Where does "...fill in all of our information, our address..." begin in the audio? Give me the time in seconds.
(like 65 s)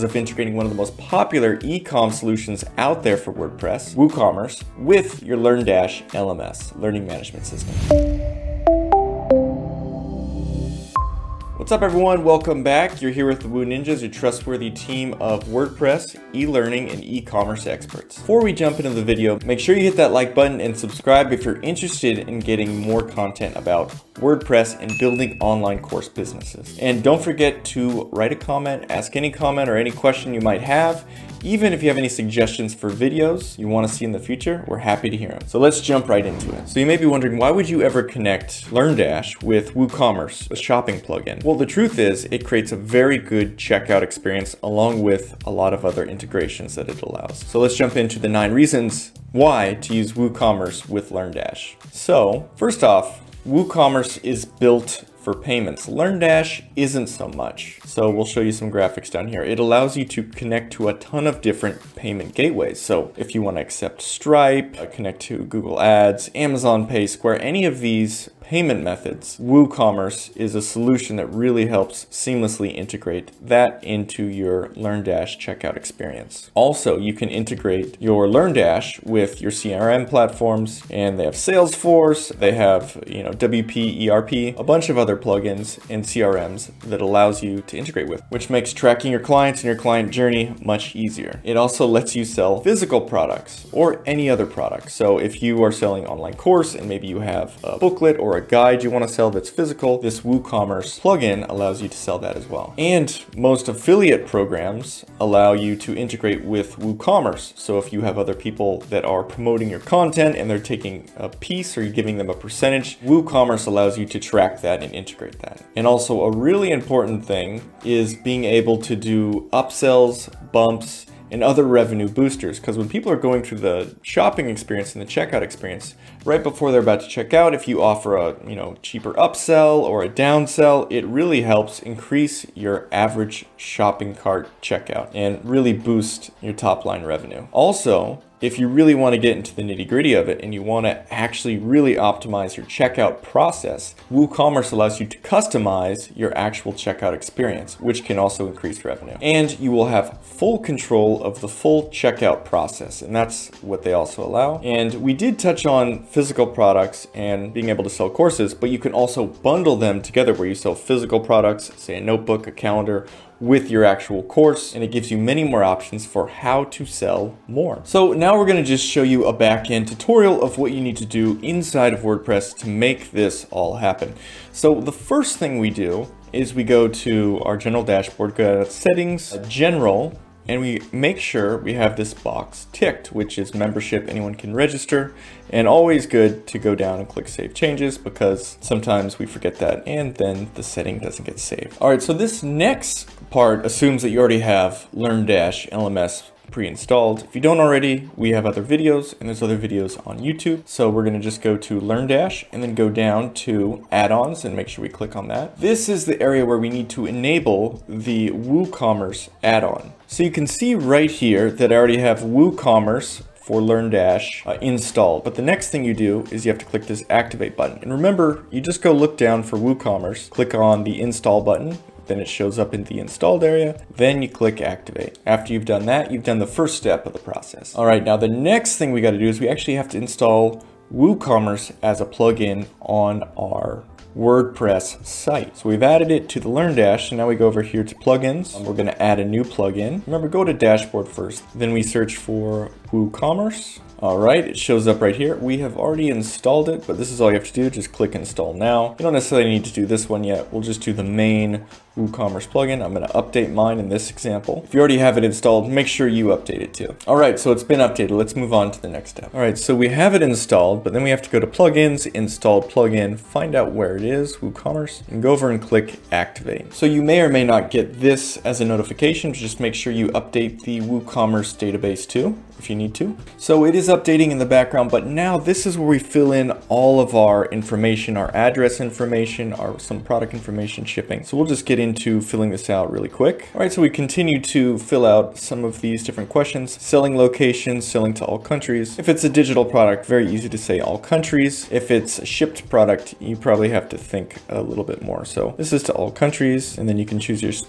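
275 s.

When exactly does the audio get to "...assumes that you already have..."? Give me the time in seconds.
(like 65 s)
193 s.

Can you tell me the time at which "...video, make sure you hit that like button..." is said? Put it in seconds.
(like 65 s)
19 s.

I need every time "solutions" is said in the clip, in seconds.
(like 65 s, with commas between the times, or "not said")
2 s, 70 s.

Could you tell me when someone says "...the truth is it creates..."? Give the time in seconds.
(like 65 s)
41 s.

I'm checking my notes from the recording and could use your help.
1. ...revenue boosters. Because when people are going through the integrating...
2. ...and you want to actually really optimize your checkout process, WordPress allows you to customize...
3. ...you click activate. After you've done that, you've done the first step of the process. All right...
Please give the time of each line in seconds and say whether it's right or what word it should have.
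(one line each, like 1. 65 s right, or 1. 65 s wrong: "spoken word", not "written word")
1. 121 s wrong: "shopping", not "integrating"
2. 140 s wrong: "WooCommerce", not "WordPress"
3. 224 s right.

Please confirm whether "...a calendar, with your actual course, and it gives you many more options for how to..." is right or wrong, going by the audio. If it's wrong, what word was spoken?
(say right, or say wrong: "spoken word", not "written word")
right.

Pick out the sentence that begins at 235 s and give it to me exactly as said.
So we've added it to the LearnDash, and now we go over here to plugins.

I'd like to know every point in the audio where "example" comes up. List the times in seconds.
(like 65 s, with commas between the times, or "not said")
254 s.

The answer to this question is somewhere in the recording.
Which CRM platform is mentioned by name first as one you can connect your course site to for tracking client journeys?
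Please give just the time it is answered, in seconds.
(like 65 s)
81 s.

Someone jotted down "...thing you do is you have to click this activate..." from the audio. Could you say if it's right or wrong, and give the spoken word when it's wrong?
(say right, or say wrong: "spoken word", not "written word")
right.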